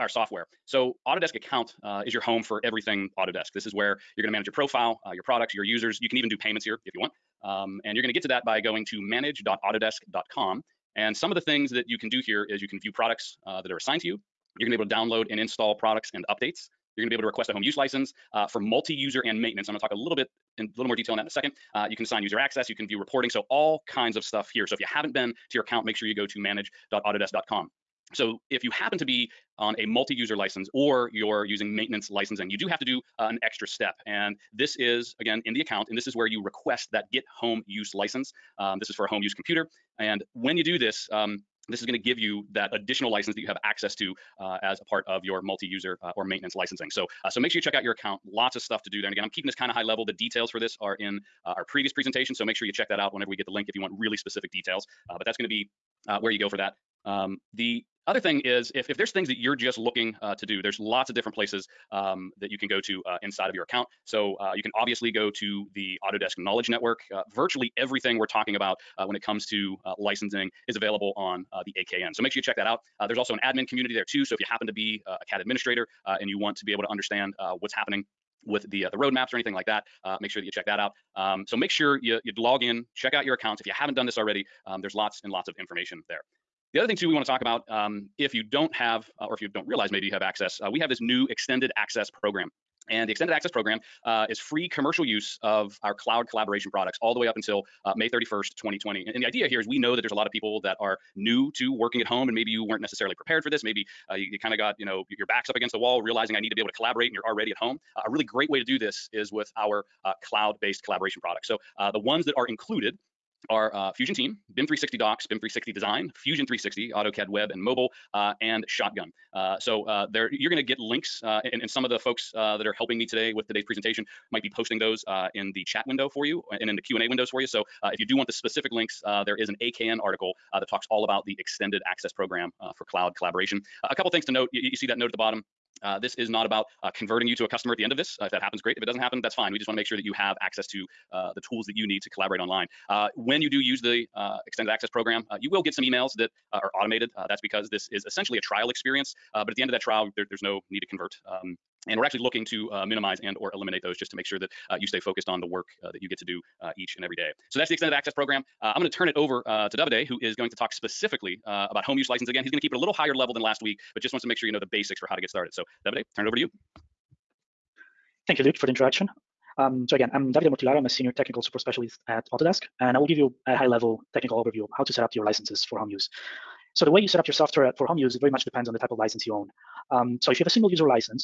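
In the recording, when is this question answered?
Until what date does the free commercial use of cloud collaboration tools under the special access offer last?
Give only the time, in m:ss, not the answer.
1:37.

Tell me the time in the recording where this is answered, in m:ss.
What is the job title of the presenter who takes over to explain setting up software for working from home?
2:50.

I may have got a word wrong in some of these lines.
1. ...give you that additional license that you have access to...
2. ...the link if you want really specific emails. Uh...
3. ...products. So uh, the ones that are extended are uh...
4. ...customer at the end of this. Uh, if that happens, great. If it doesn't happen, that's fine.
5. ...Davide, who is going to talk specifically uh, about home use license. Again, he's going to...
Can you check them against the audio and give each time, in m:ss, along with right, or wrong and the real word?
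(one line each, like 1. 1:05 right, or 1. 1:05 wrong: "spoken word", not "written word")
1. 0:41 right
2. 0:53 wrong: "details", not "emails"
3. 1:51 wrong: "included", not "extended"
4. 2:17 right
5. 2:39 right.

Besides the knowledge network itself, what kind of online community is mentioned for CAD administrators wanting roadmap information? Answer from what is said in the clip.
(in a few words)
Admin community.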